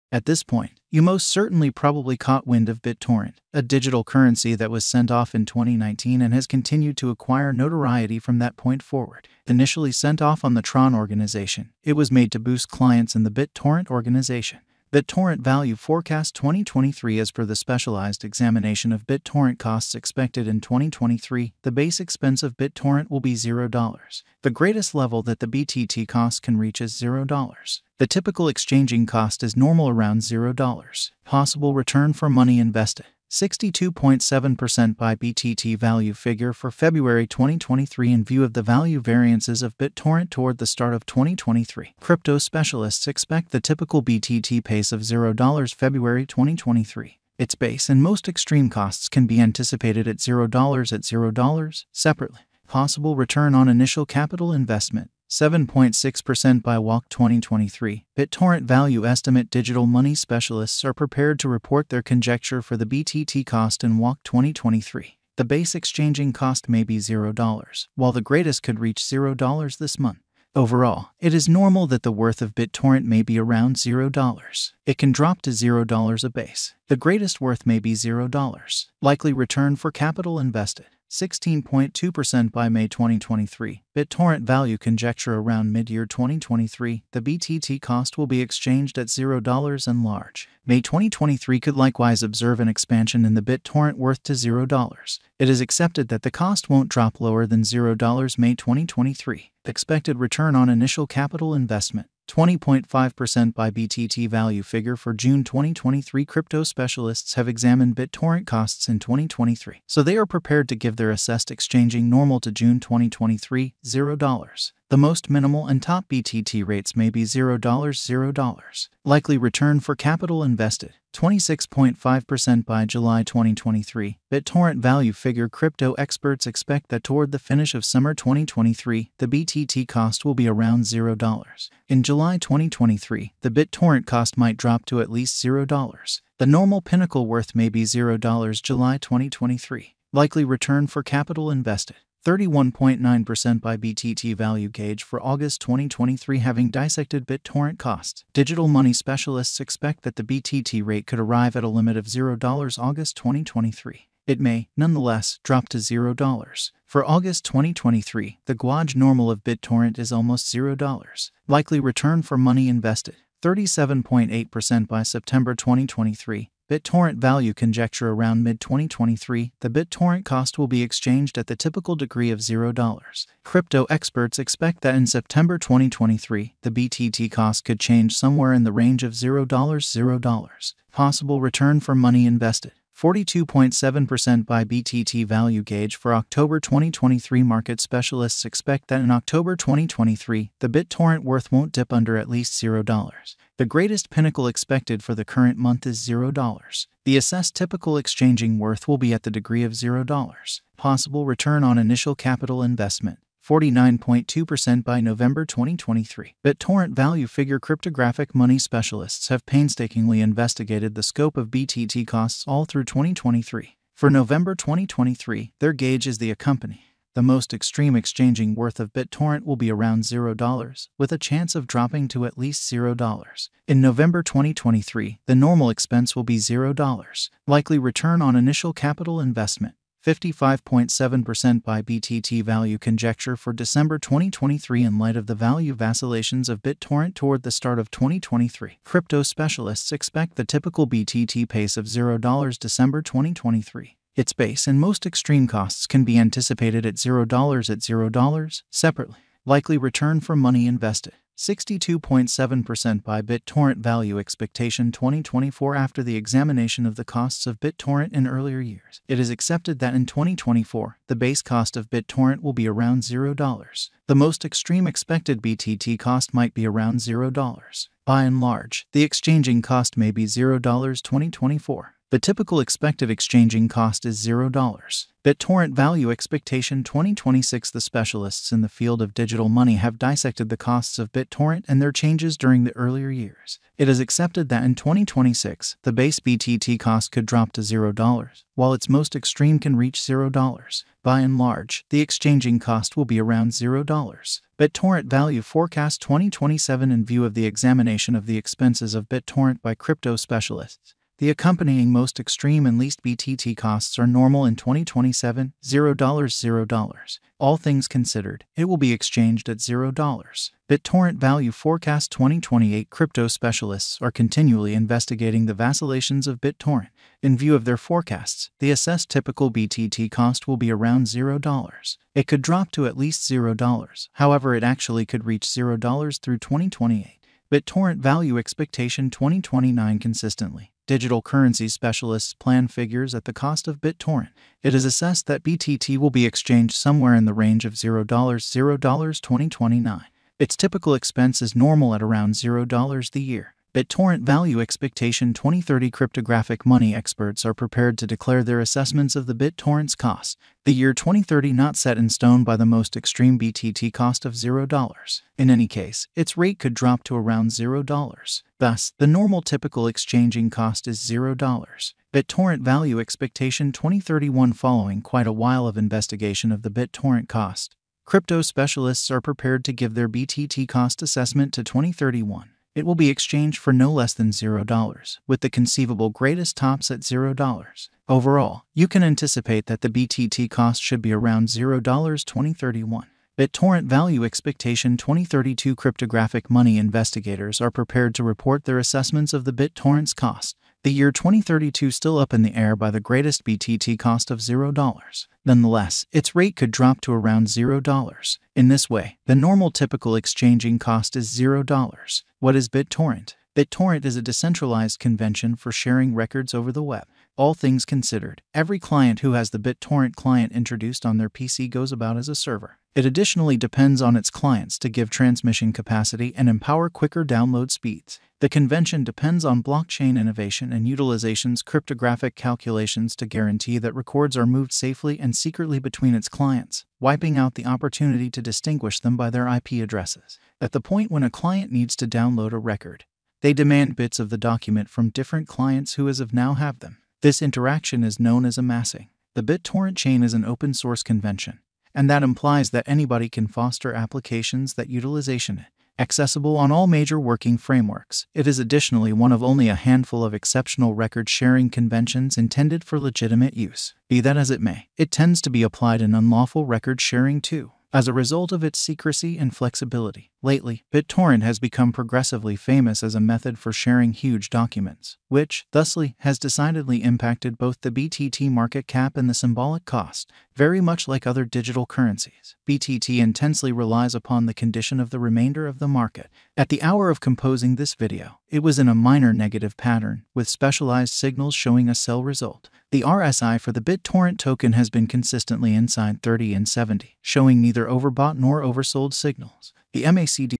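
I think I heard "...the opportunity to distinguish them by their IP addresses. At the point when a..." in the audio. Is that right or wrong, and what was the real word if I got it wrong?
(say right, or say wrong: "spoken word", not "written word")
right.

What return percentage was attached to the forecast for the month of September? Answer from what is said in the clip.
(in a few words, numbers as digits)
37.8%.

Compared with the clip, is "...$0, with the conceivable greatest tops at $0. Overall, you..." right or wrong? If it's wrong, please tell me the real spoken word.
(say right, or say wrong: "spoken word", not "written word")
right.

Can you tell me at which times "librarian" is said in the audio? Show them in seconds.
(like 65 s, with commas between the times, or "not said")
not said.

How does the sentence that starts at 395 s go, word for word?
Nonetheless, its rate could drop to around $0.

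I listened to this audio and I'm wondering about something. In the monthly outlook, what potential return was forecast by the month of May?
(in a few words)
16.2%.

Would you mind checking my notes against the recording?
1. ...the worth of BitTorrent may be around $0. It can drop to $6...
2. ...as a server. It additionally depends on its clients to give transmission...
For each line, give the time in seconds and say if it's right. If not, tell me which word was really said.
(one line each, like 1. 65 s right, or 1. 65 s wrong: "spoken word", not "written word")
1. 72 s wrong: "0", not "6"
2. 412 s right.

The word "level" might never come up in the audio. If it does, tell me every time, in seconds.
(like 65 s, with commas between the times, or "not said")
24 s.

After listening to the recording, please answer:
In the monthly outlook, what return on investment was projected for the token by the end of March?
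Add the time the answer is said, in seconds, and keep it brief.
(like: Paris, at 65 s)
7.6%, at 55 s.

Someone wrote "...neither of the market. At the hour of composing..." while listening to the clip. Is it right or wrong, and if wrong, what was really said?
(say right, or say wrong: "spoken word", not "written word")
wrong: "remainder", not "neither".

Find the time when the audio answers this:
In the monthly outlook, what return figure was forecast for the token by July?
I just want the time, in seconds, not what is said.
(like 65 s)
121 s.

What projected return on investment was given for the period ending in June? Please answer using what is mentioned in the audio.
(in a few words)
20.5%.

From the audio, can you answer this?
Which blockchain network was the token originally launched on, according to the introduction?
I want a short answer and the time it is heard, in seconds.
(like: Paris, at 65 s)
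Tron, at 10 s.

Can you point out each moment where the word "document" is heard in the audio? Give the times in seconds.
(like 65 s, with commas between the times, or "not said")
434 s, 464 s.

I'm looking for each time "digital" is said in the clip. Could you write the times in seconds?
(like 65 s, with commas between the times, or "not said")
3 s, 59 s, 148 s, 279 s, 330 s, 471 s.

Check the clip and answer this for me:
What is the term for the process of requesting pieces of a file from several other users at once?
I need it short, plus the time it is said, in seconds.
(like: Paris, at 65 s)
amassing, at 438 s.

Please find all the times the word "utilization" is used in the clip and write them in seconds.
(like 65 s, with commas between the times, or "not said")
420 s, 444 s.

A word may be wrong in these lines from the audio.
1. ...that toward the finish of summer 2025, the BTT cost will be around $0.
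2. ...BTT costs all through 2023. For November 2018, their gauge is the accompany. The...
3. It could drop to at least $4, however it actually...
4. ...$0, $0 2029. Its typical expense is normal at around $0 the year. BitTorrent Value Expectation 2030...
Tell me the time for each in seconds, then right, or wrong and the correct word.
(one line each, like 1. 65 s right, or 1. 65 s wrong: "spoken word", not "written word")
1. 126 s wrong: "2023", not "2025"
2. 211 s wrong: "2023", not "2018"
3. 322 s wrong: "0", not "4"
4. 337 s right.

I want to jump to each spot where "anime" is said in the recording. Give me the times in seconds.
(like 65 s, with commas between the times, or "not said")
not said.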